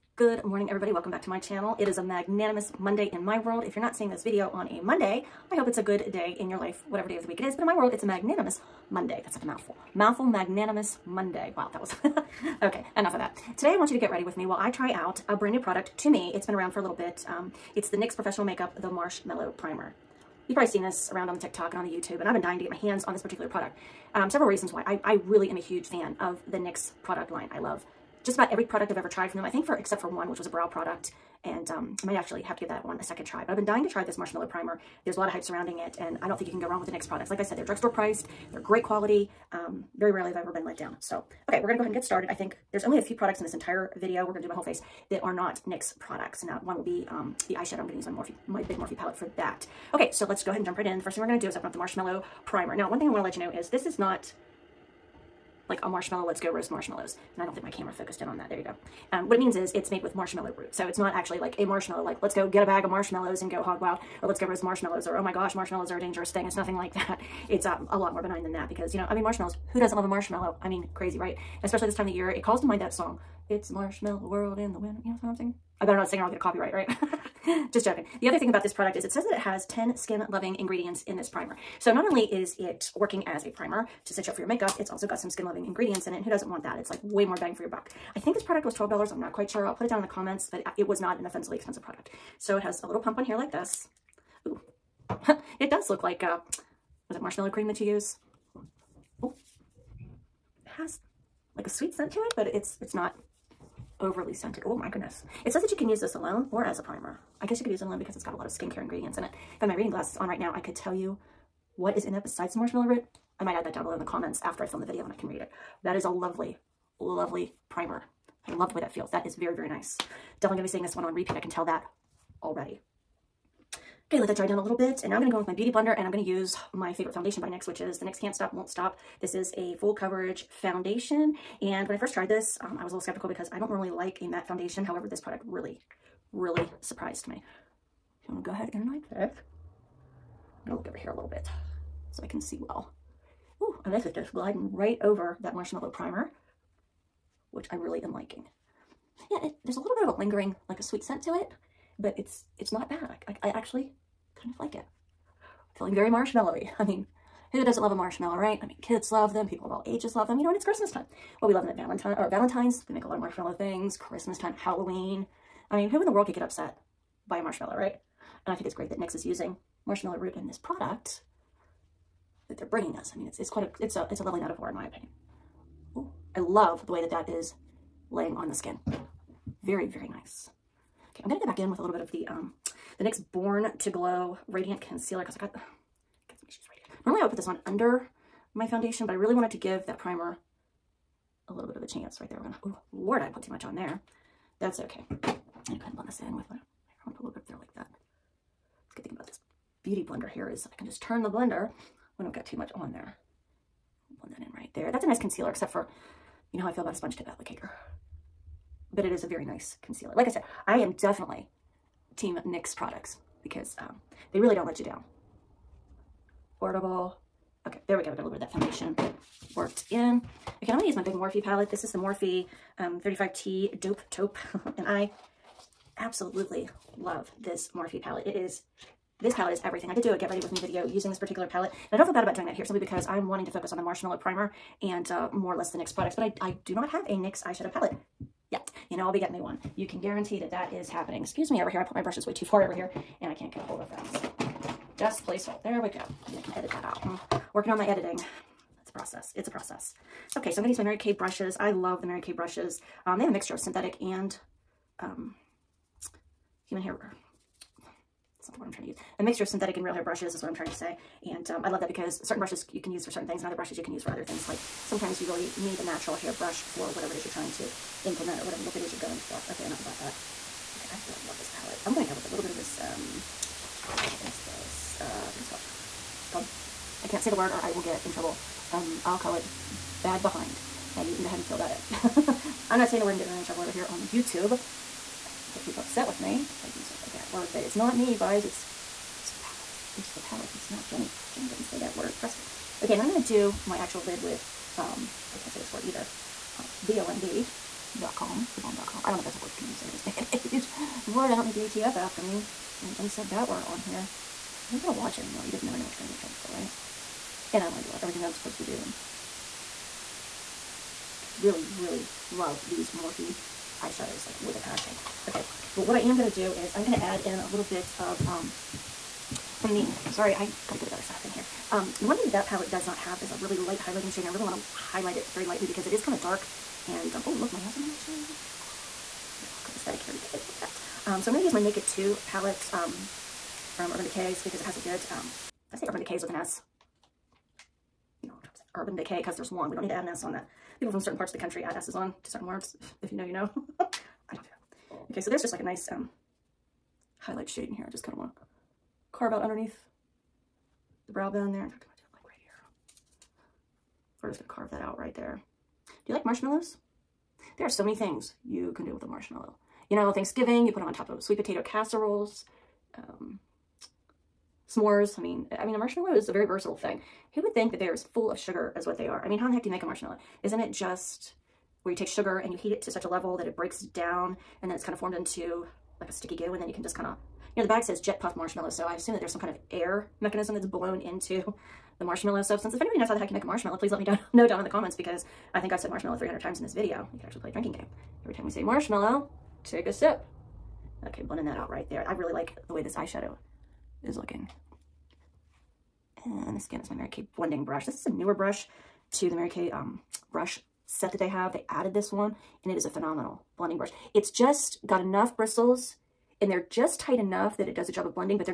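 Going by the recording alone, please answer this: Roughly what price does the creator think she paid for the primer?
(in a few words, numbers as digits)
$12.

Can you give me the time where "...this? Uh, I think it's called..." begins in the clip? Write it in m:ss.
4:34.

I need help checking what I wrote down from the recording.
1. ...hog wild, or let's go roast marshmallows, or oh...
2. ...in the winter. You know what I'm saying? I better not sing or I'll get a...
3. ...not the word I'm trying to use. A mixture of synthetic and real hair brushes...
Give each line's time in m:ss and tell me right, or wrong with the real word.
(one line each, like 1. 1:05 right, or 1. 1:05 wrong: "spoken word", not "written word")
1. 1:03 right
2. 1:14 right
3. 4:18 right.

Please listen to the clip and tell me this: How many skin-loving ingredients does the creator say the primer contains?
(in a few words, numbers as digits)
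10.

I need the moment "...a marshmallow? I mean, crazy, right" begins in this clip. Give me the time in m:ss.
1:10.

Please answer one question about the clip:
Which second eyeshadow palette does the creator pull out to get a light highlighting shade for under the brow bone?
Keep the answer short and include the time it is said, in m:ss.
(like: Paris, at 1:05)
Naked 2, at 5:31.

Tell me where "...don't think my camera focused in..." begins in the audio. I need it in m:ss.
0:57.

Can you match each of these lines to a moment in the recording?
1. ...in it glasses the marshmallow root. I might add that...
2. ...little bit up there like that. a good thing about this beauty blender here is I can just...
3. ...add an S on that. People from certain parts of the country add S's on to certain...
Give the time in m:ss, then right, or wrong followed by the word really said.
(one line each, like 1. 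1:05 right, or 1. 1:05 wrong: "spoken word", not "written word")
1. 1:52 wrong: "besides", not "glasses"
2. 3:17 right
3. 5:39 right.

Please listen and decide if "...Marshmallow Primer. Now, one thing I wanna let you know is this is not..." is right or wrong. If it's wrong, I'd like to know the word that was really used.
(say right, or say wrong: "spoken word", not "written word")
right.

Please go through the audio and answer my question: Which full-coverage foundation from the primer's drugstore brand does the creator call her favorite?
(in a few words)
Can't Stop, Won't Stop.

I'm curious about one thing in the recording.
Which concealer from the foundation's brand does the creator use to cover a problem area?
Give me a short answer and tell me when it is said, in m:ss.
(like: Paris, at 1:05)
Born to Glow Radiant Concealer, at 3:03.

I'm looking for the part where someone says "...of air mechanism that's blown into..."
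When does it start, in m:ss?
6:19.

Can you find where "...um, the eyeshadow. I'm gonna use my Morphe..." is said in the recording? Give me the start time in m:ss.
0:47.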